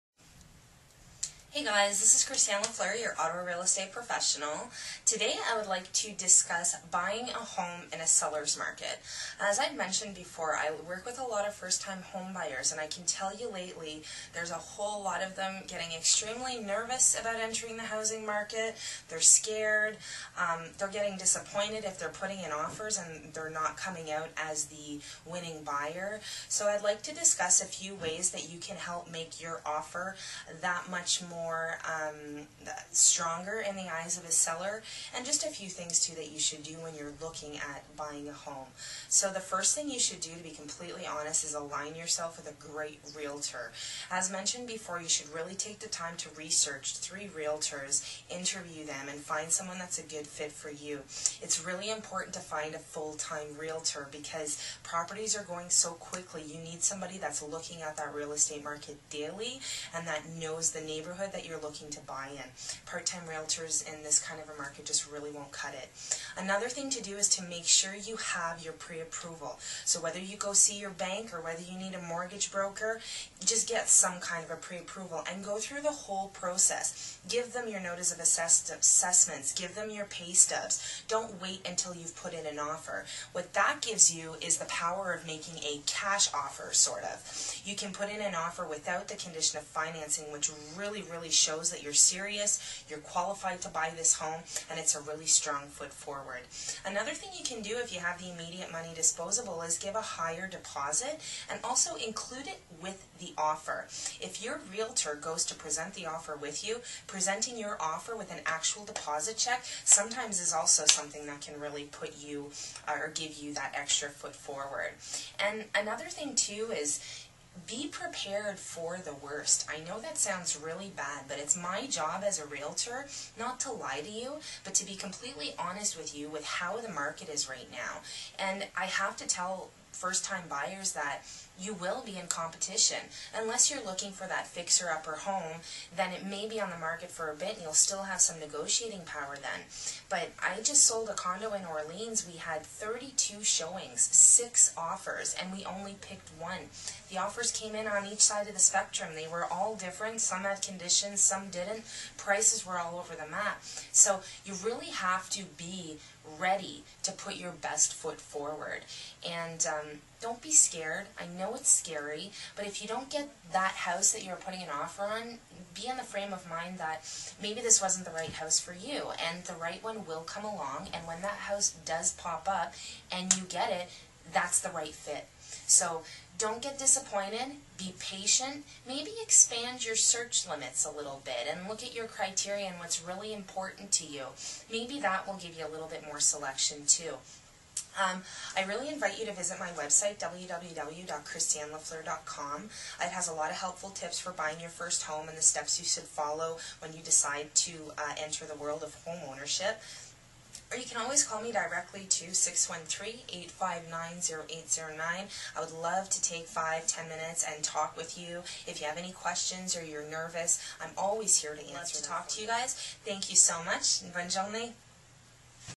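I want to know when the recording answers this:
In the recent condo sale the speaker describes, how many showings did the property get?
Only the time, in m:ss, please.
2:22.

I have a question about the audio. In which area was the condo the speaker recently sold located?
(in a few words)
Orleans.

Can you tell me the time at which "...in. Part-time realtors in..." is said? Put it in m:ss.
1:02.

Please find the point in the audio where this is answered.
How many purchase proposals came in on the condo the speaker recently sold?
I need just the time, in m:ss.
2:24.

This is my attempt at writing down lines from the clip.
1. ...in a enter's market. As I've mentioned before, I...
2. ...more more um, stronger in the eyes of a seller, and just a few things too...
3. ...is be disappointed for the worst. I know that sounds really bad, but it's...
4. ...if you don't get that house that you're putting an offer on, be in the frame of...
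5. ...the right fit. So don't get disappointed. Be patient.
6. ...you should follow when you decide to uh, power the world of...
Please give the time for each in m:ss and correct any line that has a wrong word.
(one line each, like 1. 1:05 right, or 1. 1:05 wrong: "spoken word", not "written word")
1. 0:07 wrong: "seller", not "enter"
2. 0:31 right
3. 1:56 wrong: "prepared", not "disappointed"
4. 2:42 right
5. 2:54 right
6. 3:15 wrong: "enter", not "power".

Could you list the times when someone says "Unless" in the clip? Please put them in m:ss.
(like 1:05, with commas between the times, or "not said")
2:13.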